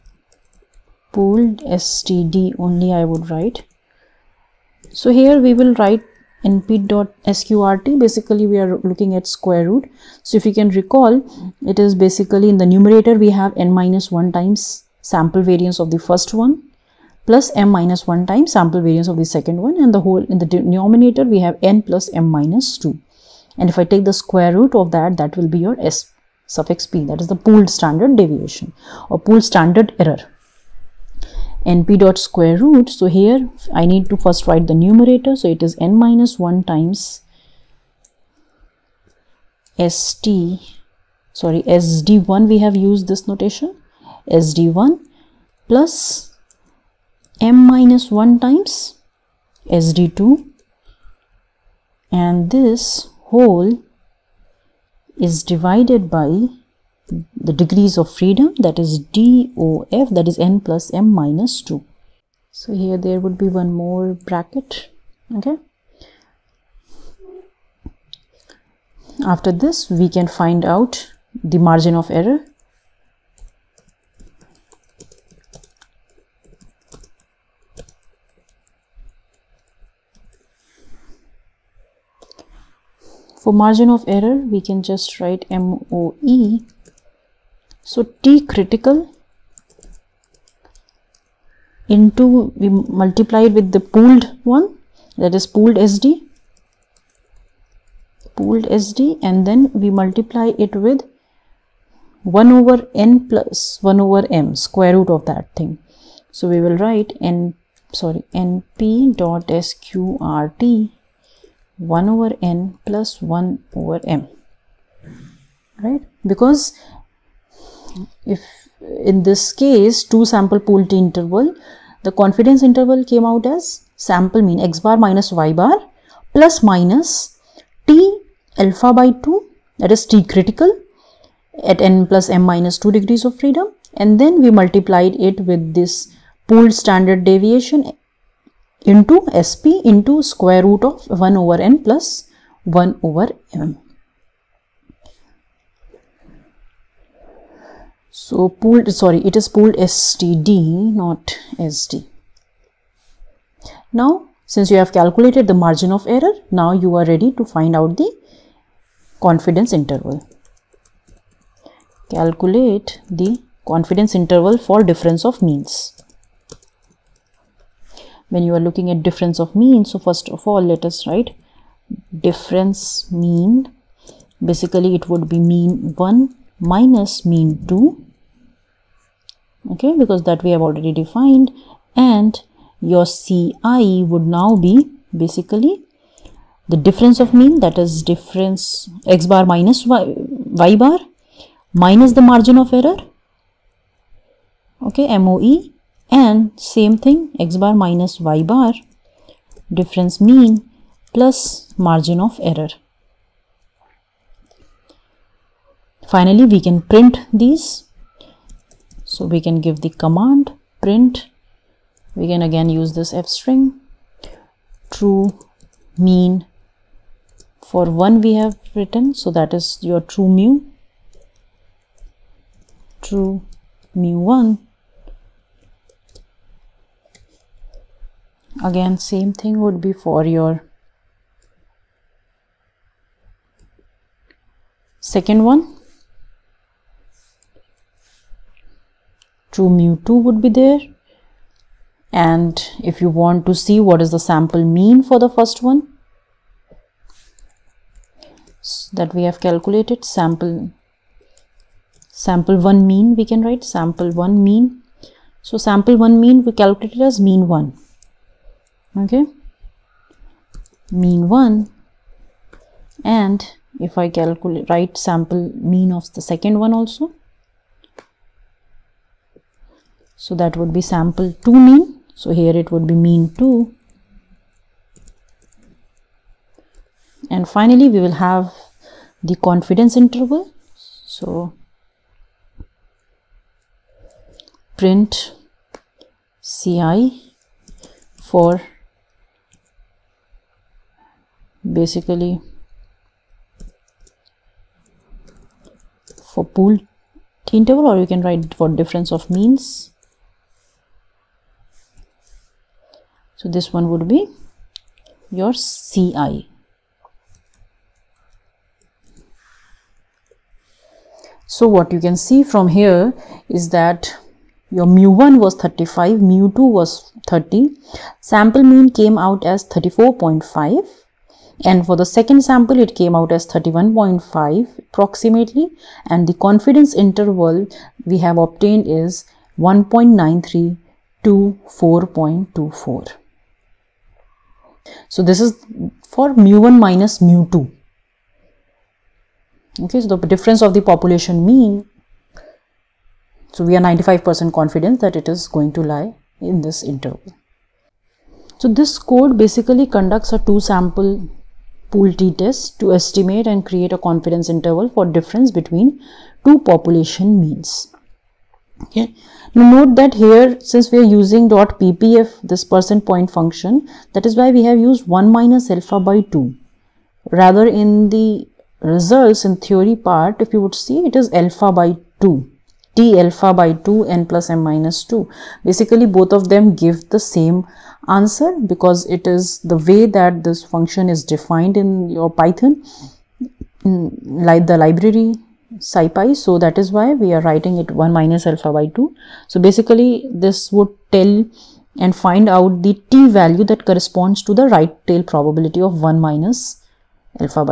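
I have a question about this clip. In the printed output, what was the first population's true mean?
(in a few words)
35.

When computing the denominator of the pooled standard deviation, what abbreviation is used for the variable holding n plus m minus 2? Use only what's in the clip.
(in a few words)
DOF.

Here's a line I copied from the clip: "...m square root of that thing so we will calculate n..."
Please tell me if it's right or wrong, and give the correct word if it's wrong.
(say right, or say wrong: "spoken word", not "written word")
wrong: "write", not "calculate".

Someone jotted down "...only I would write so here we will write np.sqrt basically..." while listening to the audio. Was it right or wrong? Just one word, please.
right.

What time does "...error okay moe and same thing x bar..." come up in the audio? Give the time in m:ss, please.
3:12.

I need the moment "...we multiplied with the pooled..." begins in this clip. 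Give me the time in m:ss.
1:32.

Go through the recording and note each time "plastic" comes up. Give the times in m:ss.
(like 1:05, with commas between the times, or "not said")
not said.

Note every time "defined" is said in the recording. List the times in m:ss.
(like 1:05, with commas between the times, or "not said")
3:00, 6:21.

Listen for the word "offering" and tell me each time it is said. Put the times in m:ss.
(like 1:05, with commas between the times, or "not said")
not said.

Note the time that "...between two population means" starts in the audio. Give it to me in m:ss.
5:55.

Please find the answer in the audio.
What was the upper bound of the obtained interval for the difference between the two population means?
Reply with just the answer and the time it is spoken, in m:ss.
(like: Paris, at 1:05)
4.24, at 5:31.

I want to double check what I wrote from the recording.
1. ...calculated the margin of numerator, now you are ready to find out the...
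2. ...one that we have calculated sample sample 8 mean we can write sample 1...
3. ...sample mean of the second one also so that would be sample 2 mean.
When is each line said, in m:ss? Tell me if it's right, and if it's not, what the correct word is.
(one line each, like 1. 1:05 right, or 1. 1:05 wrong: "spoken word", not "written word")
1. 2:34 wrong: "error", not "numerator"
2. 4:05 wrong: "1", not "8"
3. 4:25 right.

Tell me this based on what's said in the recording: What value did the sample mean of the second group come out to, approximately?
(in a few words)
31.5.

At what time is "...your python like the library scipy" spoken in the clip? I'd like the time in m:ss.
6:22.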